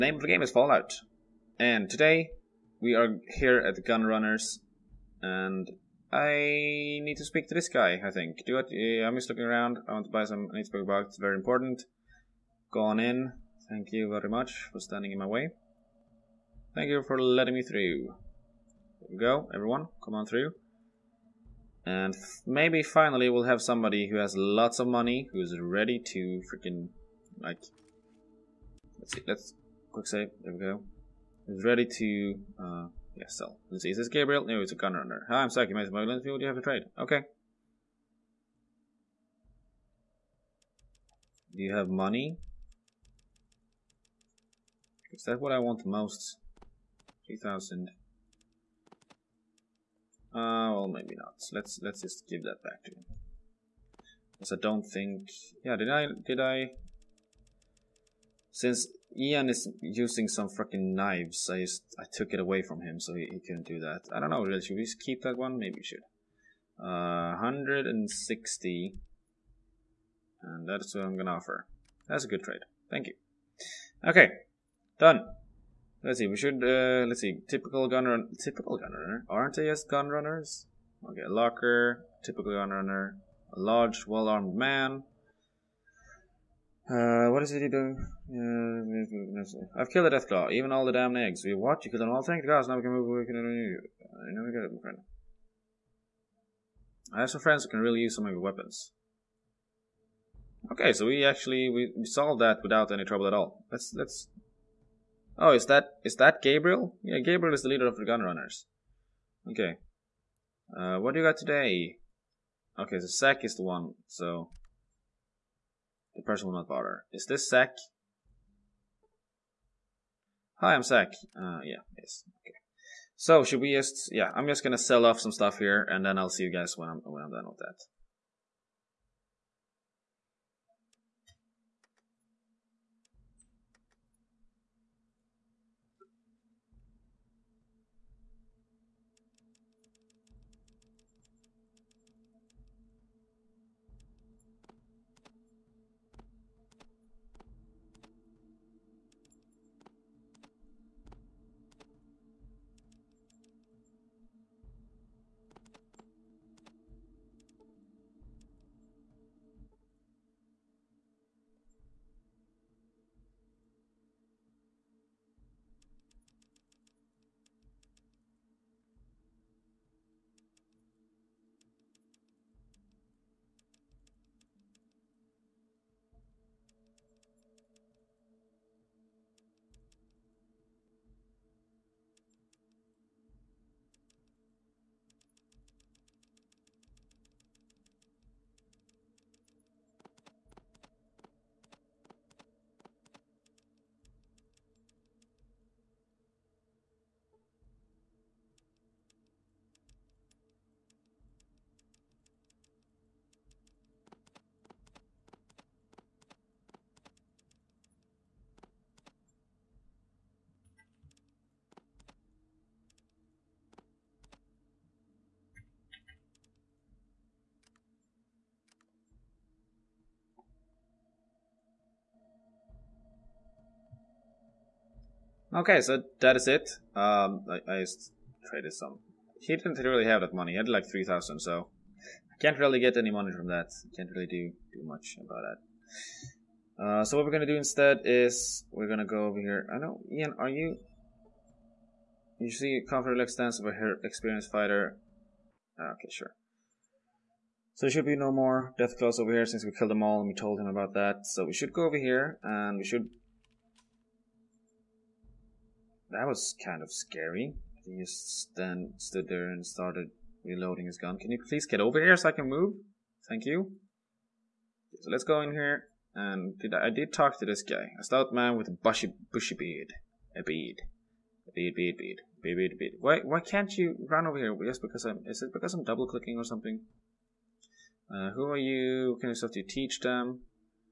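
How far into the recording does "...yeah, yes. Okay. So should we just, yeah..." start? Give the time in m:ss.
2:01.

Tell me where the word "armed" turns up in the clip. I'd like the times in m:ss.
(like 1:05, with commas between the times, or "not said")
1:24.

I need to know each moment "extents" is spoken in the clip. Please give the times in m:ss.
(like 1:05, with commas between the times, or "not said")
4:03.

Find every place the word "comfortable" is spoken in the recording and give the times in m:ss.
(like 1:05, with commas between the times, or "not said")
4:02.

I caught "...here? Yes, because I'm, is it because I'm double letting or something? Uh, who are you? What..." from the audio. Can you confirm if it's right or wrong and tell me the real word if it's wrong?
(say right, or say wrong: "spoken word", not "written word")
wrong: "clicking", not "letting".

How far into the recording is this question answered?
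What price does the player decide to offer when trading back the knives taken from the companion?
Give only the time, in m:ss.
1:07.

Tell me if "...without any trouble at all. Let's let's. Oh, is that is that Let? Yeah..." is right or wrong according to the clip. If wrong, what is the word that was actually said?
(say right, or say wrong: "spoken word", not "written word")
wrong: "Gabriel", not "Let".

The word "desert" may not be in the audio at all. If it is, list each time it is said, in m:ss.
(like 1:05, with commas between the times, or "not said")
not said.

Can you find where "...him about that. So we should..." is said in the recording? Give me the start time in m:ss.
4:10.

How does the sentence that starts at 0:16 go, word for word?
Thank you for letting me through.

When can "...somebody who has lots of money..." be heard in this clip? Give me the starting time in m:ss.
0:23.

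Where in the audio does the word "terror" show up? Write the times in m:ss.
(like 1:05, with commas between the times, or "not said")
not said.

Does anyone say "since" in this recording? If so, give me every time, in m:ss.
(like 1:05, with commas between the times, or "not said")
0:58, 4:09.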